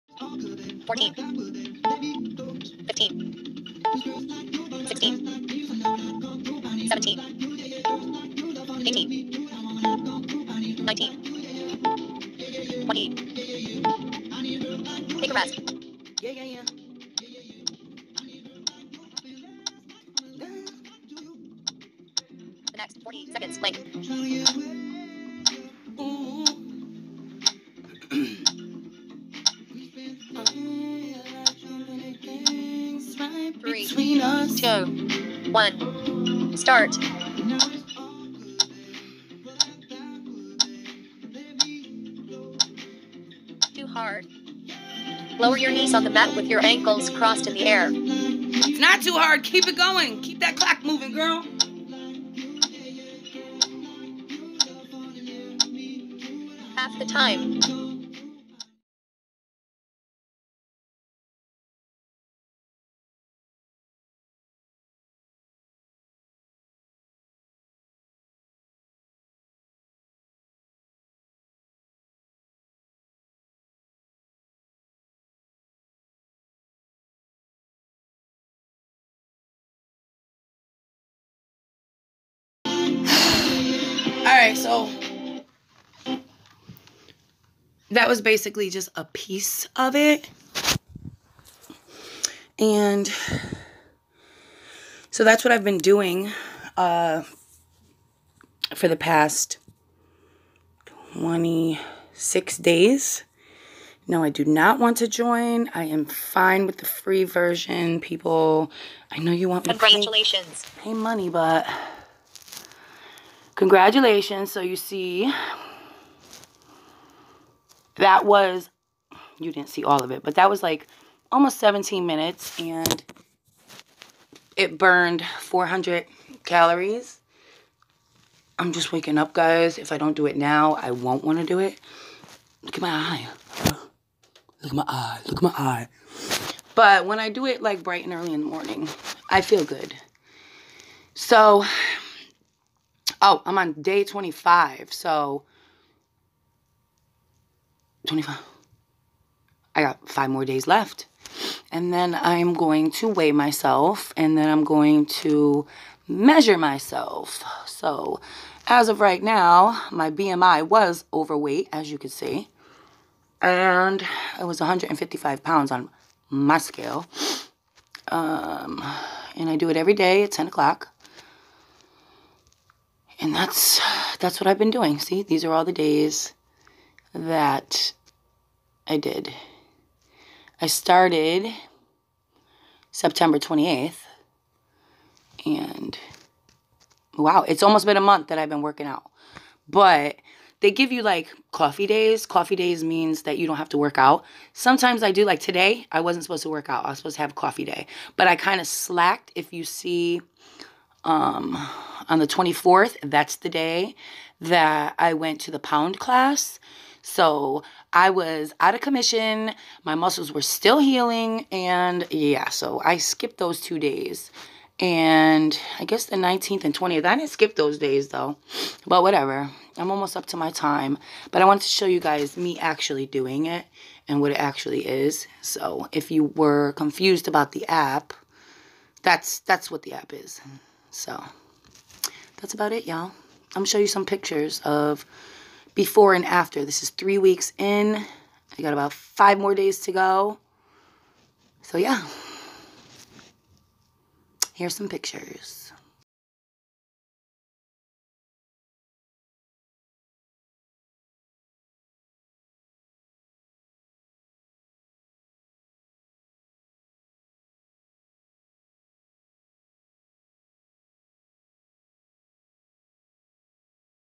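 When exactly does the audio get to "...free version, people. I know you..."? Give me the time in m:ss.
1:46.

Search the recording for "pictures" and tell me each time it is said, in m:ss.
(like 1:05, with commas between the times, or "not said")
3:54, 4:04.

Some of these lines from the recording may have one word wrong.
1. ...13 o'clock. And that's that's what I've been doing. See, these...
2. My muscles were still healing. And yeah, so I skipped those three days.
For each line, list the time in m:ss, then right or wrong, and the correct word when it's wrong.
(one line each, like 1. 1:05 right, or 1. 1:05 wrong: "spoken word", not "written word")
1. 2:50 wrong: "10", not "13"
2. 3:29 wrong: "two", not "three".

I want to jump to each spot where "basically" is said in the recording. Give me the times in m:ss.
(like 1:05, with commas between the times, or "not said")
1:28.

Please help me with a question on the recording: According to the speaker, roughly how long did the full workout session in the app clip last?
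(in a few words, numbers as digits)
almost 17 minutes.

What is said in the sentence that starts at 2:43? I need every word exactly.
And it was 155 pounds on my scale.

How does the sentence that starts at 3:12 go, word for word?
Coffee days means that you don't have to work out.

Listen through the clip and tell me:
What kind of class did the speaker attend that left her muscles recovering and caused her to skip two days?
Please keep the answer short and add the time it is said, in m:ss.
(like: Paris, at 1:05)
pound class, at 3:25.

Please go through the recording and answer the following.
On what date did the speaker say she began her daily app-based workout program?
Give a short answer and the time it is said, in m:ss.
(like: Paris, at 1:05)
September 28th, at 3:02.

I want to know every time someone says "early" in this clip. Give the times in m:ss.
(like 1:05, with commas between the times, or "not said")
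2:18.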